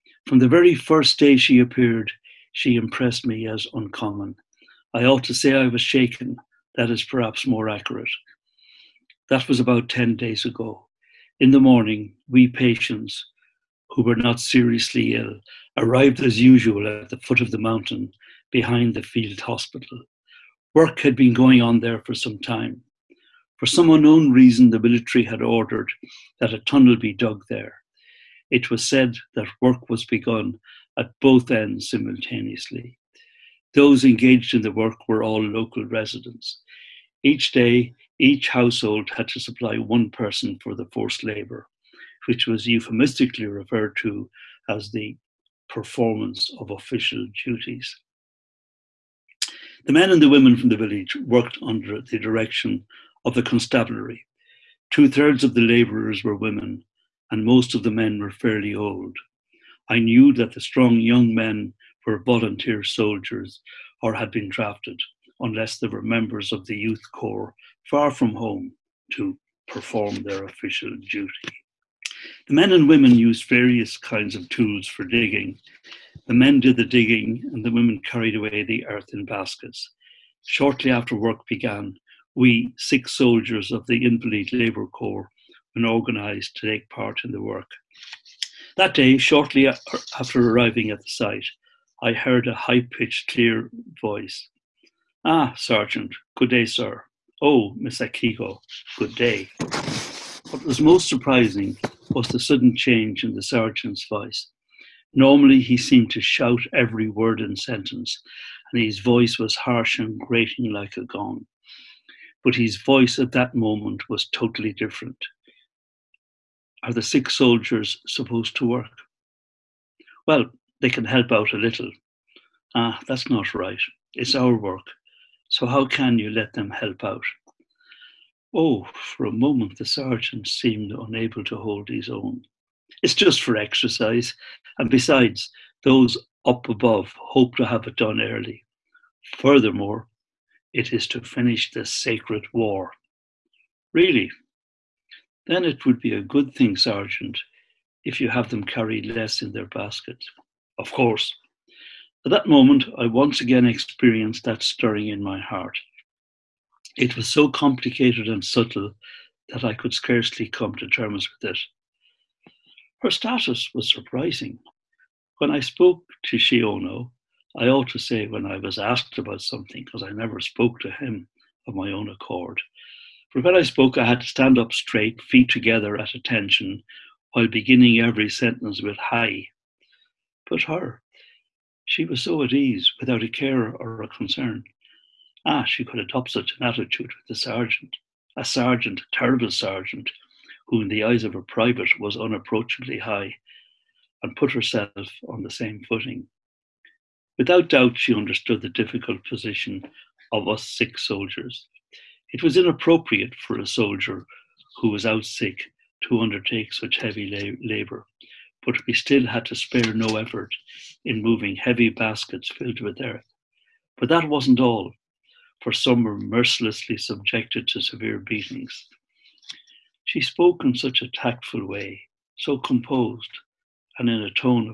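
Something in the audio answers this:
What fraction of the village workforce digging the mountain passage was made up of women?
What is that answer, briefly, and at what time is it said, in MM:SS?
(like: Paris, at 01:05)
Two thirds, at 00:54.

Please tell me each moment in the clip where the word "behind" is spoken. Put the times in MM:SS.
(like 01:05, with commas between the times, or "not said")
00:18.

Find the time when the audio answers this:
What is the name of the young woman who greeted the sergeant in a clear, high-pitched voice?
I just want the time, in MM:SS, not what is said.
01:37.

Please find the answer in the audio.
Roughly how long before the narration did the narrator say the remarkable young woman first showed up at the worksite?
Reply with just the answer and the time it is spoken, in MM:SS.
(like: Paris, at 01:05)
about 10 days ago, at 00:09.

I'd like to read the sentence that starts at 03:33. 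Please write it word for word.
But that wasn't all for some were mercilessly subjected to severe beatings.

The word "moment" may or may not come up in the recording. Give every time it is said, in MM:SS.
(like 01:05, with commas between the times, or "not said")
01:53, 02:09, 02:32.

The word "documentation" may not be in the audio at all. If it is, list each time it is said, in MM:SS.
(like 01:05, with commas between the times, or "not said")
not said.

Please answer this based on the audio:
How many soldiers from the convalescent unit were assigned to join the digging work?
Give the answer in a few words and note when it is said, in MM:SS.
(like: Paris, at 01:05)
6, at 01:22.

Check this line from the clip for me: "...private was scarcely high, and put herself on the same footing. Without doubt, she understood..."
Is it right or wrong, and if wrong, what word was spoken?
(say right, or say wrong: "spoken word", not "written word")
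wrong: "unapproachably", not "scarcely".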